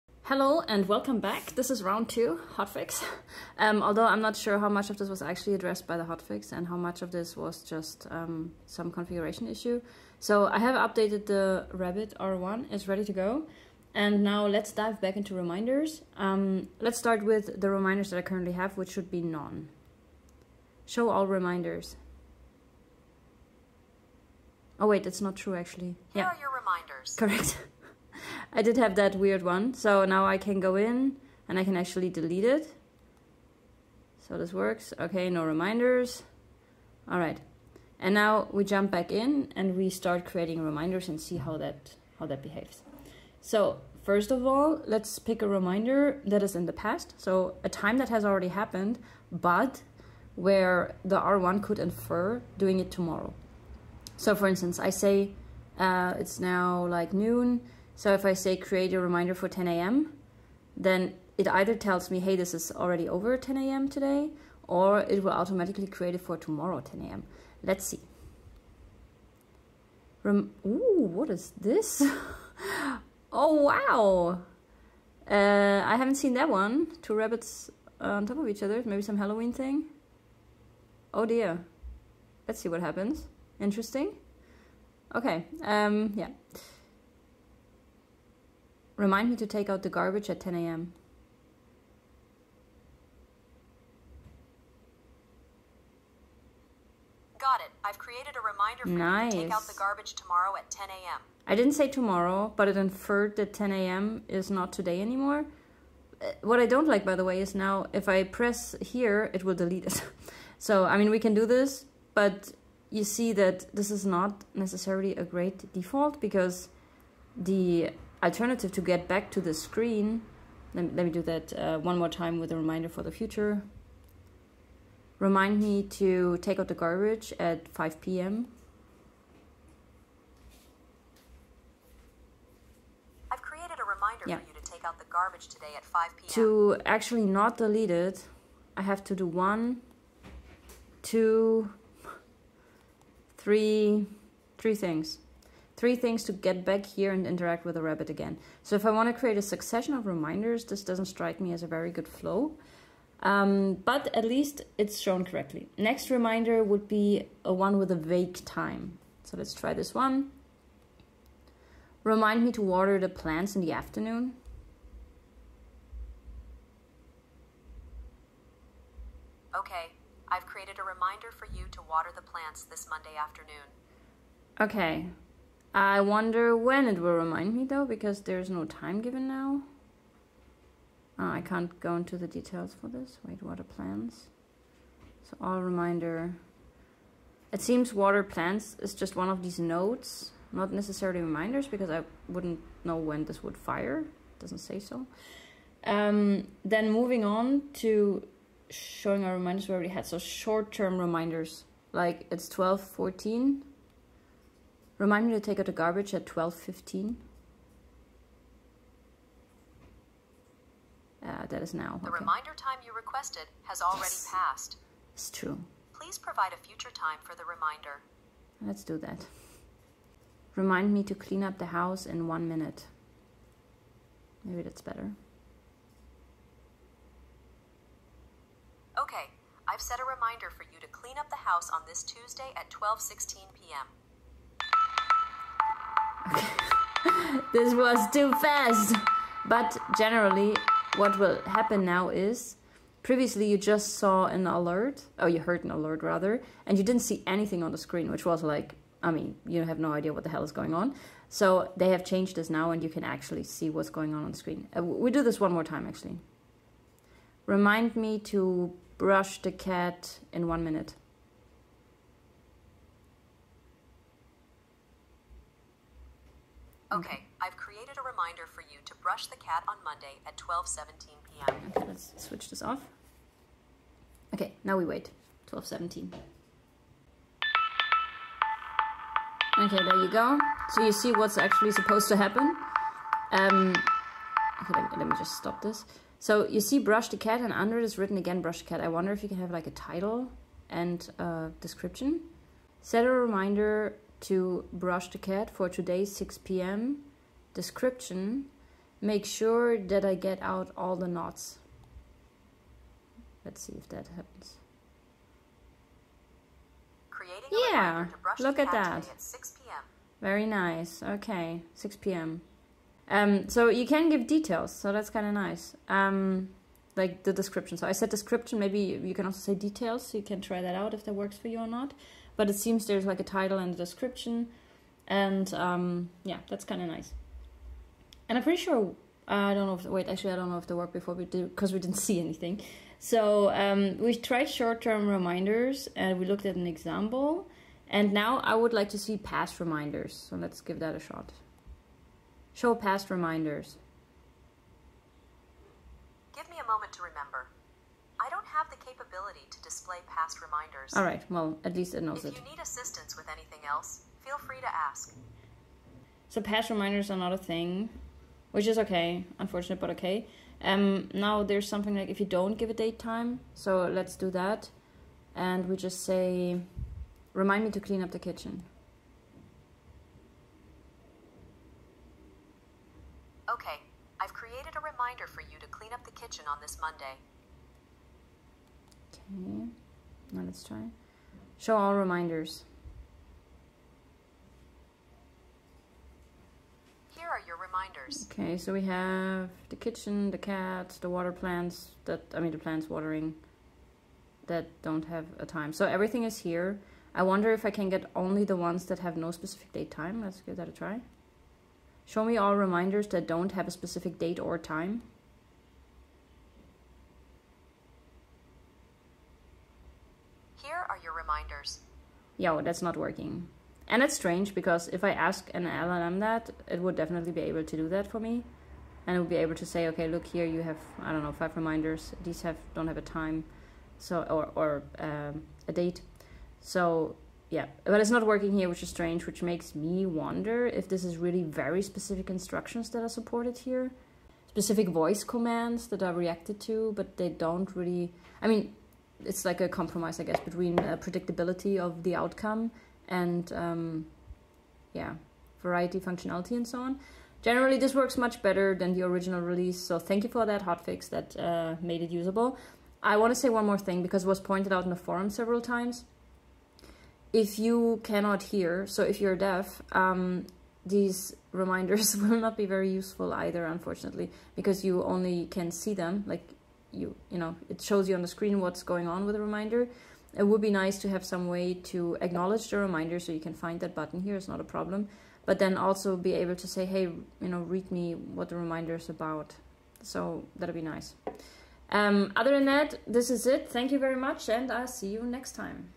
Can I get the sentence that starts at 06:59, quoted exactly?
And it would be able to say, okay, look here, you have, I don't know, five reminders.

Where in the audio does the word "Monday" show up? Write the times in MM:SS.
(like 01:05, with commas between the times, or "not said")
02:52, 04:29, 06:16.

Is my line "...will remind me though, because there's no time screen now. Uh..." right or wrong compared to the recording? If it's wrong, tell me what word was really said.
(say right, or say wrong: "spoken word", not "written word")
wrong: "given", not "screen".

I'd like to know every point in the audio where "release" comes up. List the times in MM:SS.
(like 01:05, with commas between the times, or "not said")
07:29.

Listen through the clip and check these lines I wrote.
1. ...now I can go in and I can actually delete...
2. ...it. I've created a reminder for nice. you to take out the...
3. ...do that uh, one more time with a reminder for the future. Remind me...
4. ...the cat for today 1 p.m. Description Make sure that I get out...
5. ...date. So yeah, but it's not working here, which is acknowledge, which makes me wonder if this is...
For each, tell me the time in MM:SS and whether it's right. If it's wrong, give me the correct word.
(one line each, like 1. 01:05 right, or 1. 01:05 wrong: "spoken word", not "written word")
1. 00:30 right
2. 01:37 right
3. 02:01 right
4. 04:55 wrong: "6", not "1"
5. 07:05 wrong: "strange", not "acknowledge".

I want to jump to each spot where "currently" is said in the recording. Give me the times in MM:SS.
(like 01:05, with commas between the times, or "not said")
00:18.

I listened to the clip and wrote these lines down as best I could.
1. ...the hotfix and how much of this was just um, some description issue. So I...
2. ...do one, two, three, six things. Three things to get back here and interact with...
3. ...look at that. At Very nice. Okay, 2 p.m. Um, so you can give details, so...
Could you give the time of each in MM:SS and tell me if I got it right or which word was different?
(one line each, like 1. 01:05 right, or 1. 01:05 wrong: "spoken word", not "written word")
1. 00:05 wrong: "configuration", not "description"
2. 02:19 wrong: "three", not "six"
3. 05:08 wrong: "6", not "2".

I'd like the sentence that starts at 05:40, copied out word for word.
So let's give that a shot.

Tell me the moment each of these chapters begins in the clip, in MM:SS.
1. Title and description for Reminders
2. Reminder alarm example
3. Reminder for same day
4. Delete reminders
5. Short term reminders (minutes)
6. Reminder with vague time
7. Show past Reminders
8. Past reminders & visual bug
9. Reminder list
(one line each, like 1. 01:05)
1. 04:47
2. 04:00
3. 02:00
4. 00:29
5. 03:20
6. 02:34
7. 05:41
8. 00:45
9. 01:46.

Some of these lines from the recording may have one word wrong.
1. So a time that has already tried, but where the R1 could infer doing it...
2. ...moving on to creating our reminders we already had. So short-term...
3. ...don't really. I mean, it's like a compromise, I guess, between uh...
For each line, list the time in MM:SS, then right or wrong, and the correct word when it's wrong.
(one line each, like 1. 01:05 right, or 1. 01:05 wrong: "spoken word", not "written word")
1. 00:47 wrong: "happened", not "tried"
2. 03:16 wrong: "showing", not "creating"
3. 07:17 right.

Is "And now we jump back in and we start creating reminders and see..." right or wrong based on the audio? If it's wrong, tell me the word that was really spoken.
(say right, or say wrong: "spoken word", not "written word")
right.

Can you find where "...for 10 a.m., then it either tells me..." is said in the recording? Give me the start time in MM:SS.
00:59.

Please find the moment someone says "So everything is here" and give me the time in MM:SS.
06:35.